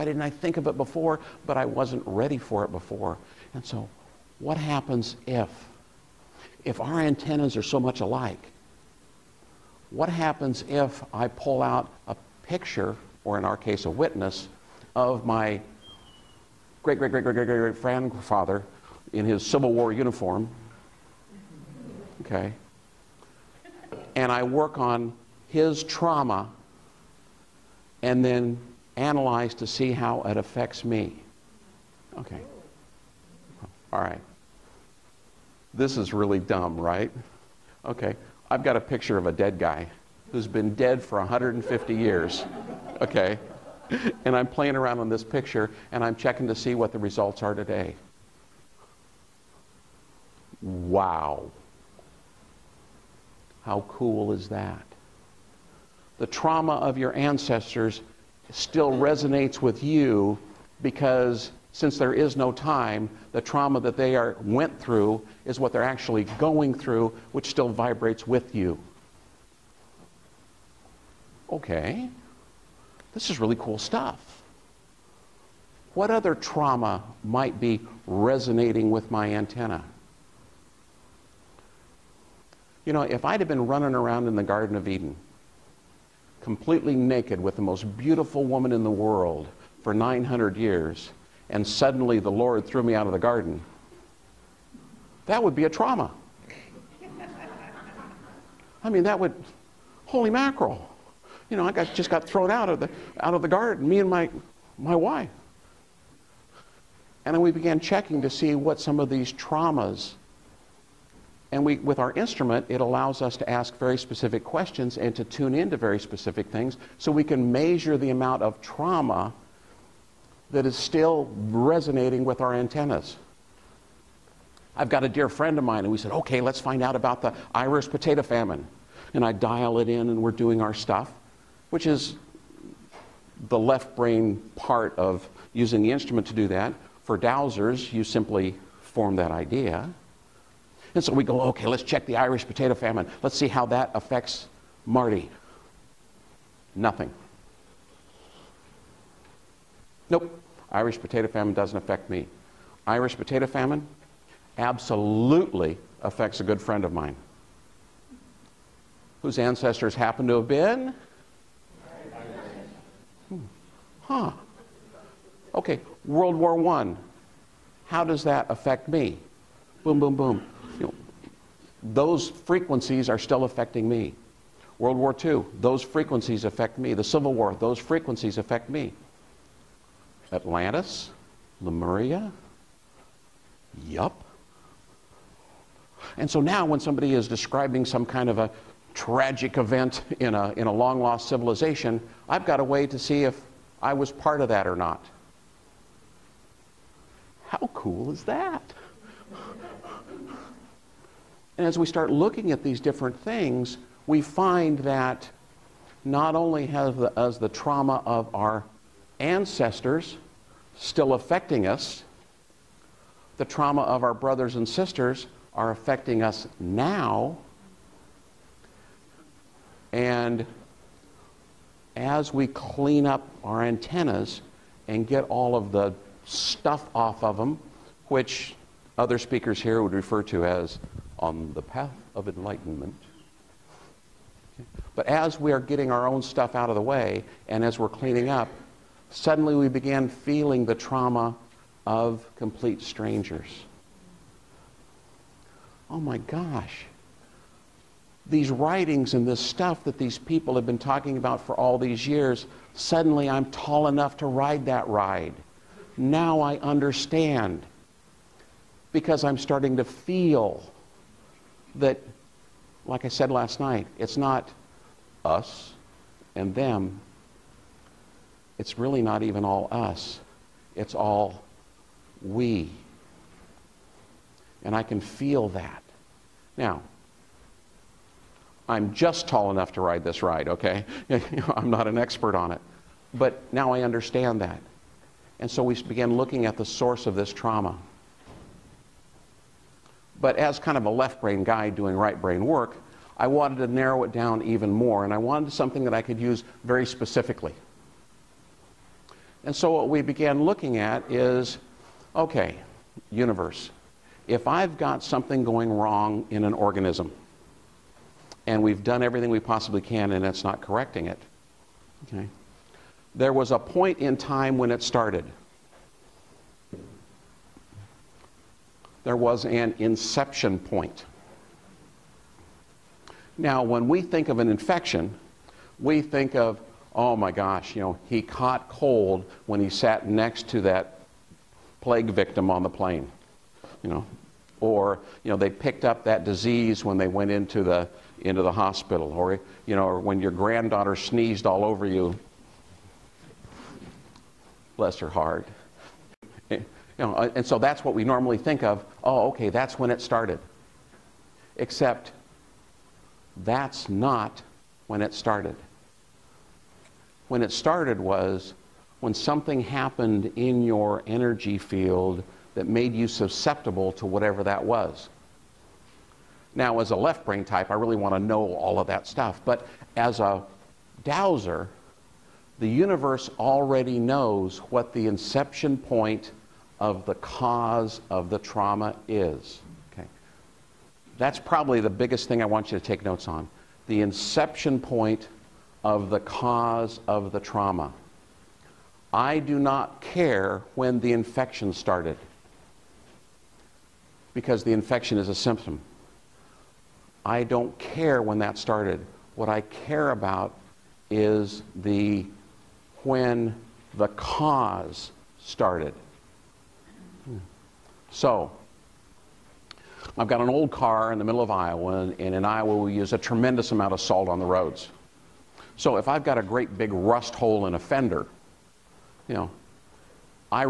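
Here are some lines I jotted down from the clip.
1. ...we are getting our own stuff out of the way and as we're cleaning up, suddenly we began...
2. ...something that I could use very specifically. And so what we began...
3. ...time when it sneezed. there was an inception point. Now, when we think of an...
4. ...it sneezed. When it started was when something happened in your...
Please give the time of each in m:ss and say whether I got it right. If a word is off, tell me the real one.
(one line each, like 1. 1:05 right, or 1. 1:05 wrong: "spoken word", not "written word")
1. 3:55 right
2. 4:55 right
3. 5:14 wrong: "started", not "sneezed"
4. 5:55 wrong: "started", not "sneezed".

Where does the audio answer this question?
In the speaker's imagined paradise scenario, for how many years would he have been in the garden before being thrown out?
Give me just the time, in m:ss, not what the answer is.
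1:29.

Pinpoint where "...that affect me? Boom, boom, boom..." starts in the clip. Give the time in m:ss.
2:48.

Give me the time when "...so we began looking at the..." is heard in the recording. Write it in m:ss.
4:45.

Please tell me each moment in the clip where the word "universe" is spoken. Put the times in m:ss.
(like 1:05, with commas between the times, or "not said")
5:03, 6:12.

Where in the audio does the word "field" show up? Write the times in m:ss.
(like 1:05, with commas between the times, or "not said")
6:01.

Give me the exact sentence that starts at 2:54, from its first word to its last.
World War II, those frequencies affect me.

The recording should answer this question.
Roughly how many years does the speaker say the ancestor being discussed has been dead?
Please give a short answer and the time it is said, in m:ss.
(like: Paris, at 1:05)
150, at 0:41.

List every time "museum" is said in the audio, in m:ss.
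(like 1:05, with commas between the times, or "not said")
not said.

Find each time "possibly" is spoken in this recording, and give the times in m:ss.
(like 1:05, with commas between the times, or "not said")
5:09.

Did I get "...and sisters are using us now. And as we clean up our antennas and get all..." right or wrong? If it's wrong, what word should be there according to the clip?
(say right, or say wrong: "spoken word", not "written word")
wrong: "affecting", not "using".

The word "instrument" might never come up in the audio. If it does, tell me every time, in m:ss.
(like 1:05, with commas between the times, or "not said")
1:52, 2:15.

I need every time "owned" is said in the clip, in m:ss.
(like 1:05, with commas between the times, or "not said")
not said.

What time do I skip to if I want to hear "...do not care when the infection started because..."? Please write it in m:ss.
6:29.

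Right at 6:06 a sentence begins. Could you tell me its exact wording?
Now, as a left brain type, I really want to know all of that stuff.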